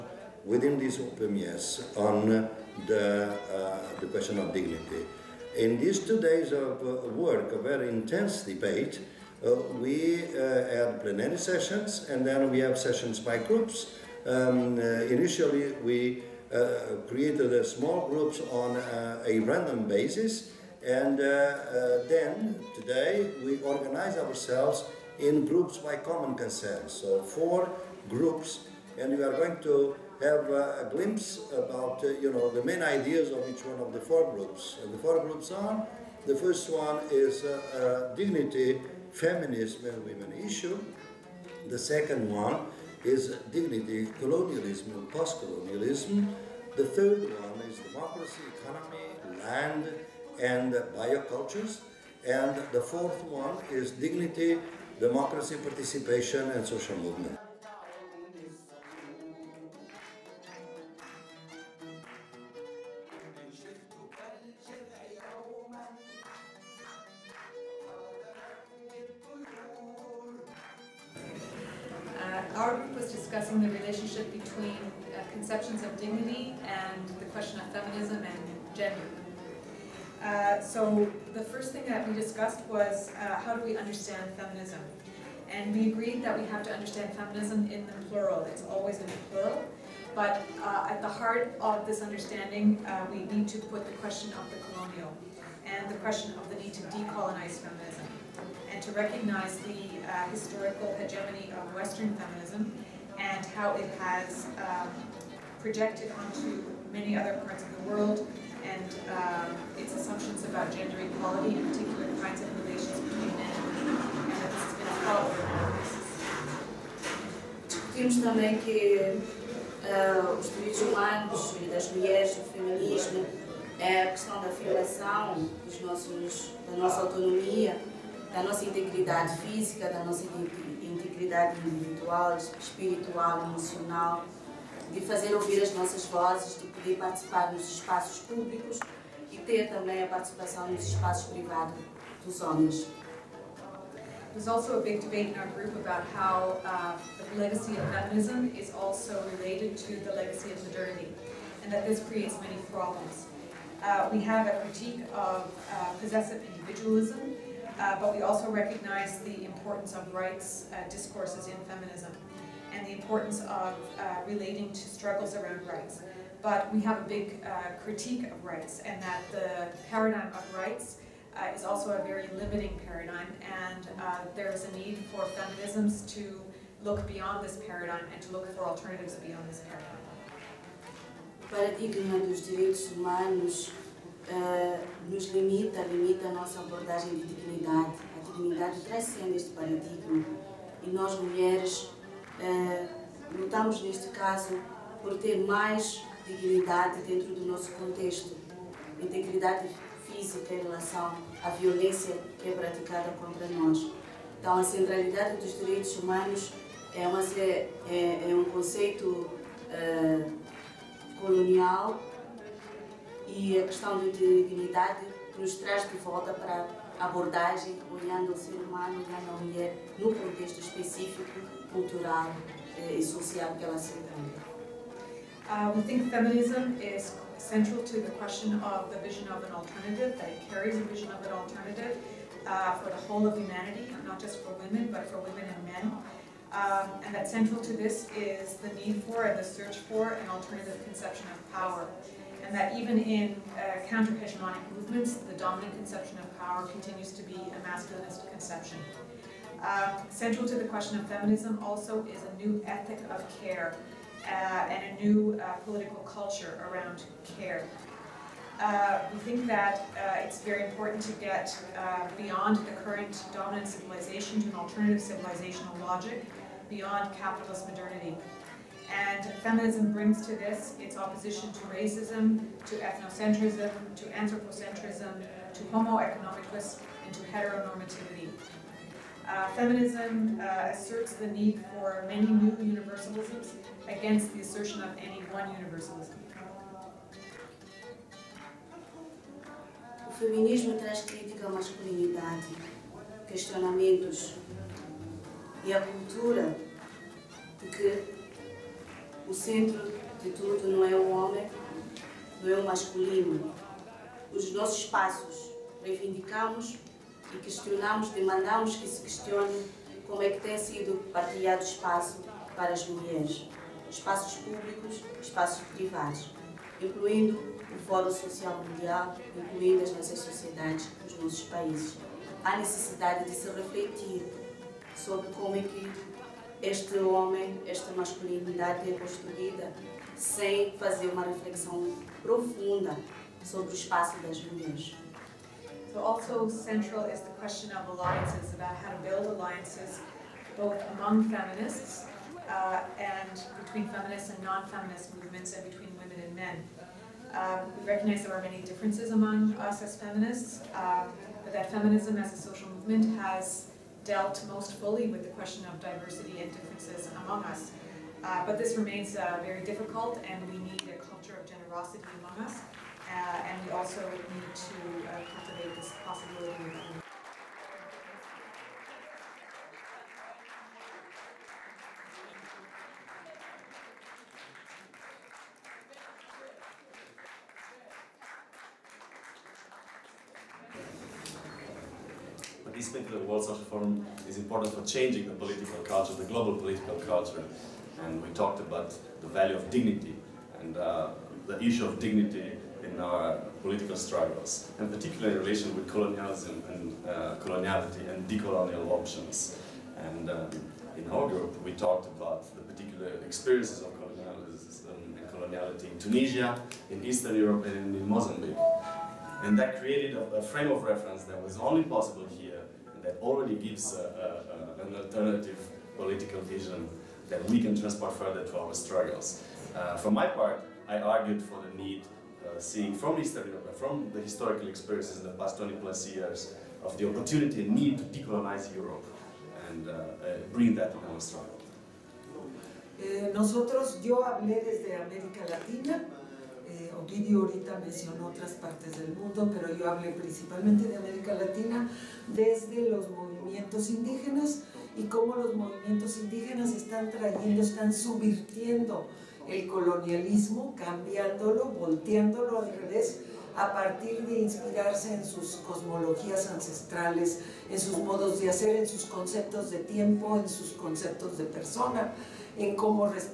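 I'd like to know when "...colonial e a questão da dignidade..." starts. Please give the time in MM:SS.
03:31.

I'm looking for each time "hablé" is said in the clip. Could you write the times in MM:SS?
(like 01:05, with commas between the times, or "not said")
07:14, 07:19.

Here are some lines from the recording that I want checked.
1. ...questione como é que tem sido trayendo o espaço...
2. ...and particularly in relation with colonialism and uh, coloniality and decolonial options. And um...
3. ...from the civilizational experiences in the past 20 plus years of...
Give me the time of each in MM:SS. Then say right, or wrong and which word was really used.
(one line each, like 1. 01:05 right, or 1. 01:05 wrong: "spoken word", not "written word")
1. 05:09 wrong: "partilhado", not "trayendo"
2. 06:34 right
3. 07:03 wrong: "historical", not "civilizational".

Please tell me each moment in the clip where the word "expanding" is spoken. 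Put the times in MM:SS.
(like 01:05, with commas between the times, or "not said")
not said.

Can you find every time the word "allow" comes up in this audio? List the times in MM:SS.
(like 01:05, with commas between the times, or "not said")
not said.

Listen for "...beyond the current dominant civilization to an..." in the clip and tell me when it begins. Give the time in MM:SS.
04:22.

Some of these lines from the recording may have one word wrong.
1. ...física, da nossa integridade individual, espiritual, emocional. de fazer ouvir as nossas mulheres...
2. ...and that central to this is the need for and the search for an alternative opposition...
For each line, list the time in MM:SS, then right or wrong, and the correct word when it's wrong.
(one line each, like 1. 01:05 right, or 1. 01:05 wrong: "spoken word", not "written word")
1. 02:09 wrong: "vozes", not "mulheres"
2. 03:57 wrong: "conception", not "opposition".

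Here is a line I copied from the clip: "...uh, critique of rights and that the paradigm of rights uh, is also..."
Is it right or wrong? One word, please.
right.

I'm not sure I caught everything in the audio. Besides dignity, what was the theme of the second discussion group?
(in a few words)
Colonialism and post-colonialism.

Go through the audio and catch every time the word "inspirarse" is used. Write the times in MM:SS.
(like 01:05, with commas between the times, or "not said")
07:34.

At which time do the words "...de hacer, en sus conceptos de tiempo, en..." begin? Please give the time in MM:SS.
07:38.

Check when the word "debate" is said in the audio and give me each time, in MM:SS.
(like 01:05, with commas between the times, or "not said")
00:08, 02:25.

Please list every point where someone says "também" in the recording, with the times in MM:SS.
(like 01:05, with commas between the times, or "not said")
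01:58, 02:19.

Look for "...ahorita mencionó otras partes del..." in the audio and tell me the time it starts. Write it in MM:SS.
07:17.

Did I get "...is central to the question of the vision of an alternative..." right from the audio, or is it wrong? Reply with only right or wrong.
right.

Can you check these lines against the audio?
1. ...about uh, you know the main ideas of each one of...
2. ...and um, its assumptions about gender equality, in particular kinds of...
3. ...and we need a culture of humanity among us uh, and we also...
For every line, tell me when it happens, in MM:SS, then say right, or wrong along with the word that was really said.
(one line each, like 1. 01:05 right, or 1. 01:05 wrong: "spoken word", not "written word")
1. 00:31 right
2. 01:48 right
3. 06:00 wrong: "generosity", not "humanity".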